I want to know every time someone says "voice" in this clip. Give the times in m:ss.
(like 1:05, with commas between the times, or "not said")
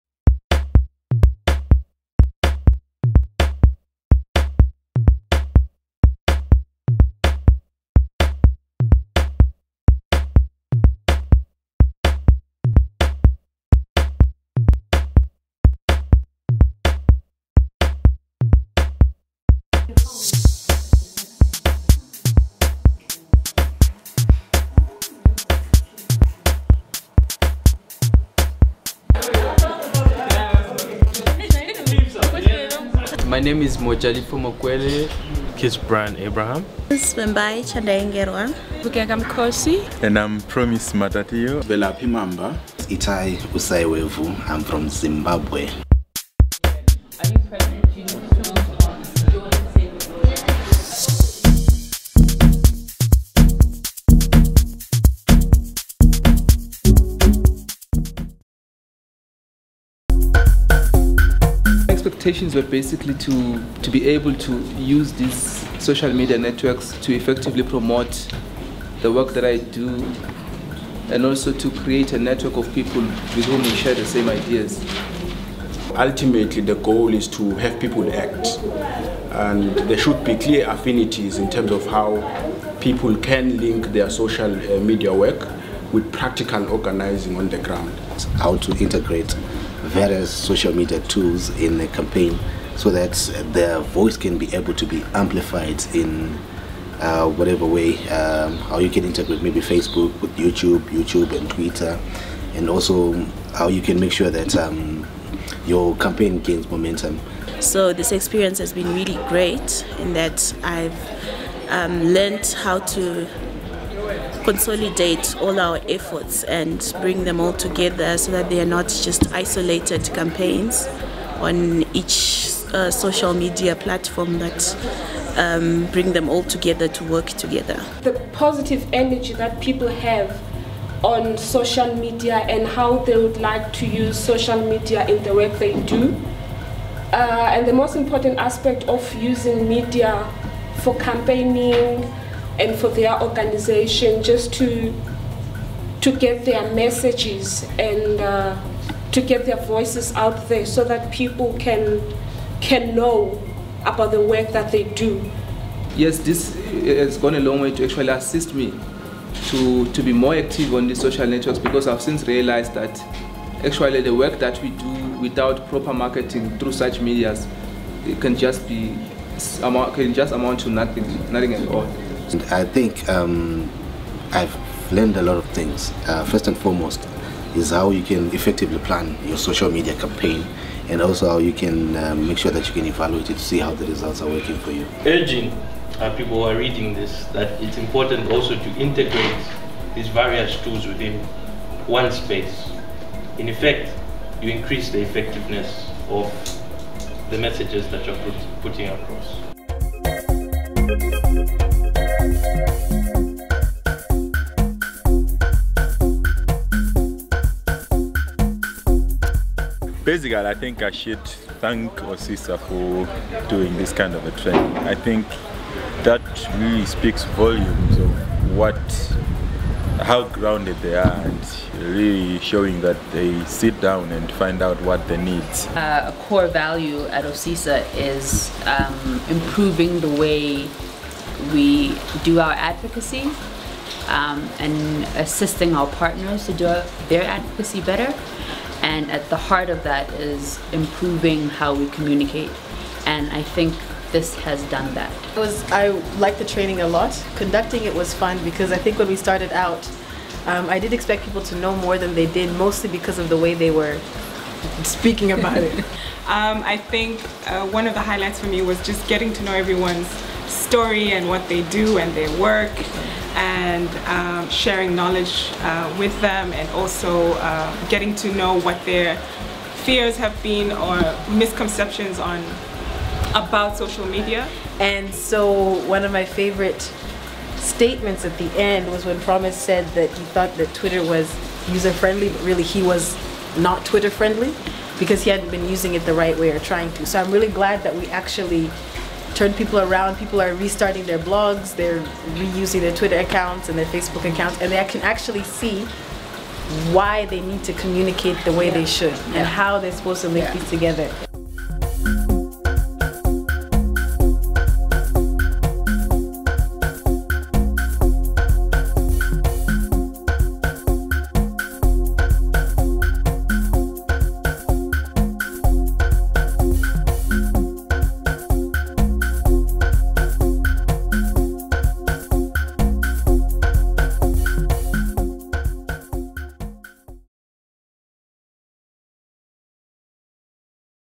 1:33, 2:29.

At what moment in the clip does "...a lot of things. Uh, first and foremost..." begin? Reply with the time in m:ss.
2:55.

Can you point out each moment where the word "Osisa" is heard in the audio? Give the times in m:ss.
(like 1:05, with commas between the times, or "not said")
3:31, 3:47.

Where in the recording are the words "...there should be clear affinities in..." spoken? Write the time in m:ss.
1:19.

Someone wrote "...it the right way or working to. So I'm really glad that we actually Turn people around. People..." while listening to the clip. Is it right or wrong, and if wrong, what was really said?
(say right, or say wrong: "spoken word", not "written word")
wrong: "trying", not "working".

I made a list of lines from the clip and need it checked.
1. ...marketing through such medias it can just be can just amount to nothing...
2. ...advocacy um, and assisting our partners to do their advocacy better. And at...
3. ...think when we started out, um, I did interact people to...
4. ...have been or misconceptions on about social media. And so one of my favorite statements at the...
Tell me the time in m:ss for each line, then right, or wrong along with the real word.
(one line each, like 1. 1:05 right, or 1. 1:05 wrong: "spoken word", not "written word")
1. 2:45 right
2. 3:52 right
3. 4:08 wrong: "expect", not "interact"
4. 4:30 right.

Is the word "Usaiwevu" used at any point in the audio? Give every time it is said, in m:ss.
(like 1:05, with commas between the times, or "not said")
0:43.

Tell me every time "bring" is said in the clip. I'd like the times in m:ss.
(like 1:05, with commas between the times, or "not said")
1:57, 2:05.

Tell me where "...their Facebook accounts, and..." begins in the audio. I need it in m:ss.
4:53.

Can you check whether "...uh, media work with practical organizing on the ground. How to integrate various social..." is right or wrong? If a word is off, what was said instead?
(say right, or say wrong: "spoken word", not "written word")
right.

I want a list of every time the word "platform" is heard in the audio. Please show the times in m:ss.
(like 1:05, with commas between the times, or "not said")
2:03.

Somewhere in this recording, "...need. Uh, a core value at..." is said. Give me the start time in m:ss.
3:45.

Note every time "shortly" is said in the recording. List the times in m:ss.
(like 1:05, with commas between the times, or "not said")
not said.